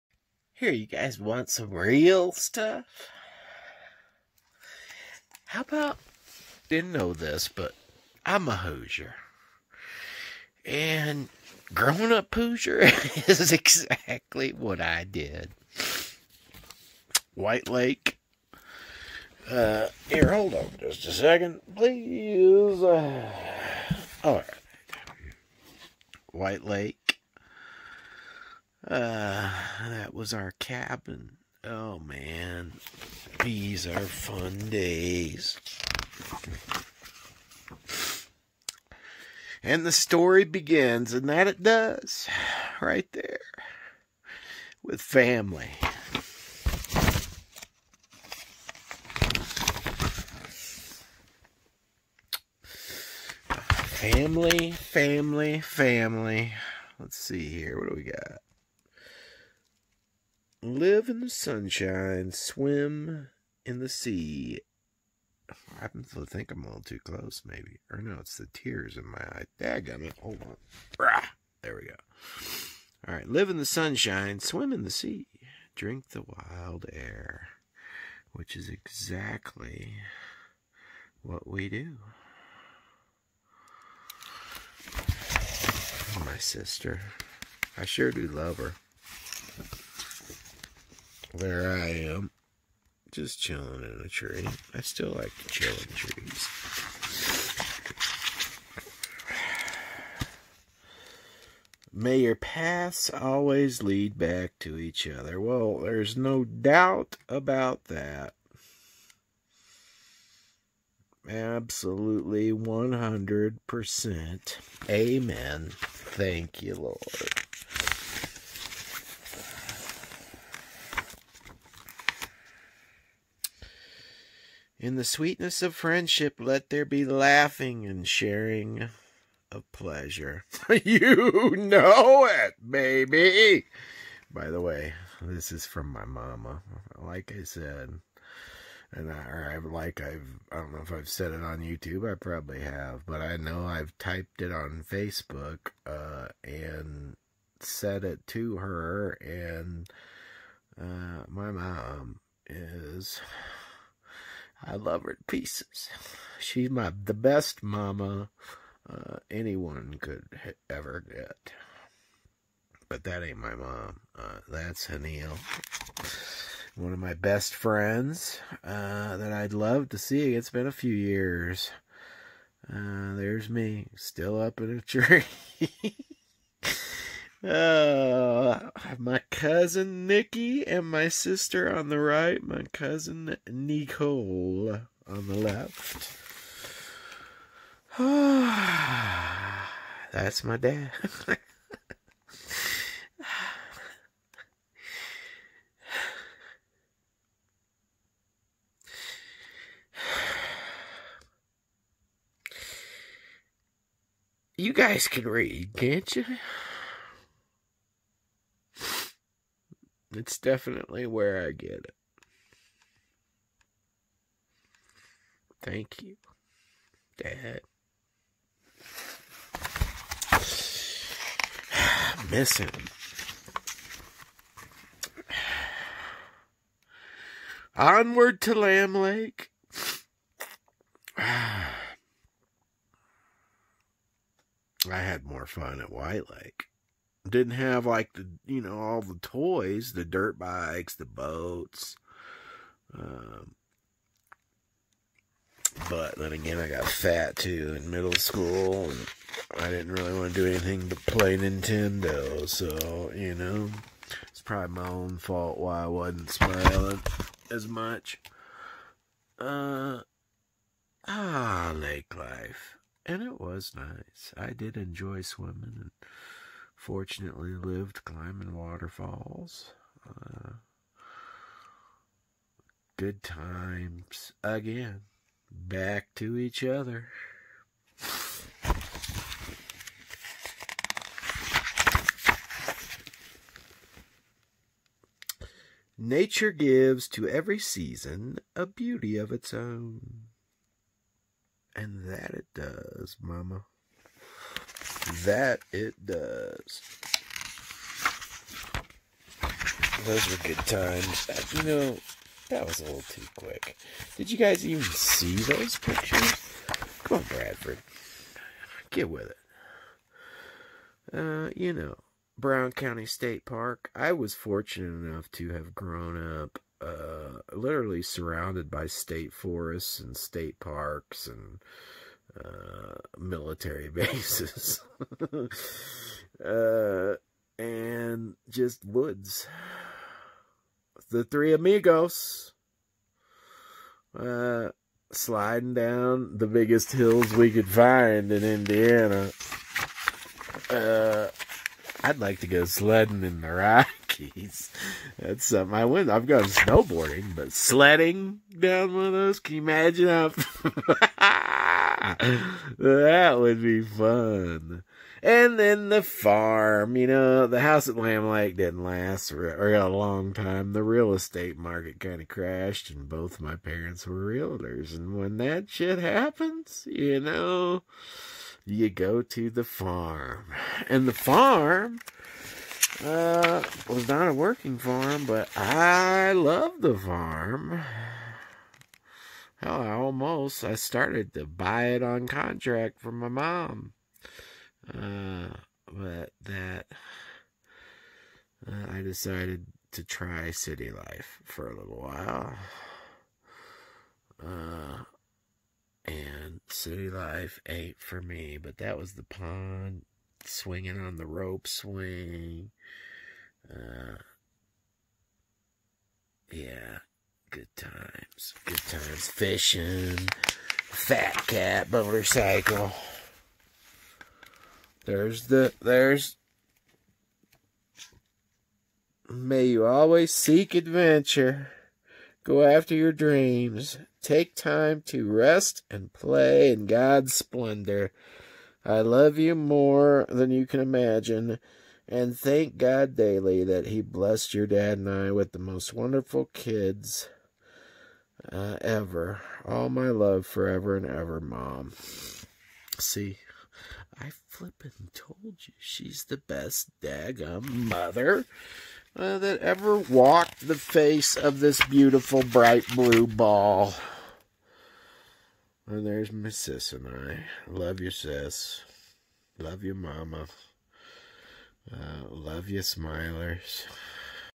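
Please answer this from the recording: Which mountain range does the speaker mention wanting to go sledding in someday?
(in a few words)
The Rockies.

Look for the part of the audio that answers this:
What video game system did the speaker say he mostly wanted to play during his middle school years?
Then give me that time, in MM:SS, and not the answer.
04:11.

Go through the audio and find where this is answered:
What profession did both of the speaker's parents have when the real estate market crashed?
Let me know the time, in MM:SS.
06:04.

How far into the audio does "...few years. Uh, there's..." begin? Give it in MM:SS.
02:50.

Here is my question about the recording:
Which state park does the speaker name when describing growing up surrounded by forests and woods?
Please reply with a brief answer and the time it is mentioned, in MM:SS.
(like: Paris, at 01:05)
Brown County State Park, at 05:12.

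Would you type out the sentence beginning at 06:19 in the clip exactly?
Hell, I almost I started to buy it on contract from my mom.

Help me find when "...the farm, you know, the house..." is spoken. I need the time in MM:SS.
05:55.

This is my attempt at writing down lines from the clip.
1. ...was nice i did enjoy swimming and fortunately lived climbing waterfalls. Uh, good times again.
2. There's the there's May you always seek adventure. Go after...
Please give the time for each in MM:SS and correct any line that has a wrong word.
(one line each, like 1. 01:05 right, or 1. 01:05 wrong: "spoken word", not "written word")
1. 04:23 right
2. 06:55 right.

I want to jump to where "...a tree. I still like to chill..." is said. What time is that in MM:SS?
01:34.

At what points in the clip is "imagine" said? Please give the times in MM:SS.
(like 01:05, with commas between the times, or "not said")
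05:49, 07:10.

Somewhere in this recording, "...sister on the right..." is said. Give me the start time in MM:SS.
03:01.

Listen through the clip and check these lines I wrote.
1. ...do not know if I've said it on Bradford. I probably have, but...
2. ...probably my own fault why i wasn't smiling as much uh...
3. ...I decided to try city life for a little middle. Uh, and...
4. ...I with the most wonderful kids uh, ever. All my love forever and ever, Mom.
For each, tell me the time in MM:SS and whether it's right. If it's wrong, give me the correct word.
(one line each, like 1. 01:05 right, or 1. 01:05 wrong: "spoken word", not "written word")
1. 02:20 wrong: "YouTube", not "Bradford"
2. 04:14 right
3. 06:28 wrong: "while", not "middle"
4. 07:15 right.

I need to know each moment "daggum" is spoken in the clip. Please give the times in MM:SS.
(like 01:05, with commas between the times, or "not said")
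01:09, 07:27.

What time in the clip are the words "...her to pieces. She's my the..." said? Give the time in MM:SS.
02:35.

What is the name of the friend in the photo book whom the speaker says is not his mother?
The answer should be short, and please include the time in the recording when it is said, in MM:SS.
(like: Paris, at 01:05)
Haneel, at 02:44.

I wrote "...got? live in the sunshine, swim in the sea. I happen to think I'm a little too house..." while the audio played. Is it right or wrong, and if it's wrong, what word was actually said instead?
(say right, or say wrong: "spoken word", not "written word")
wrong: "close", not "house".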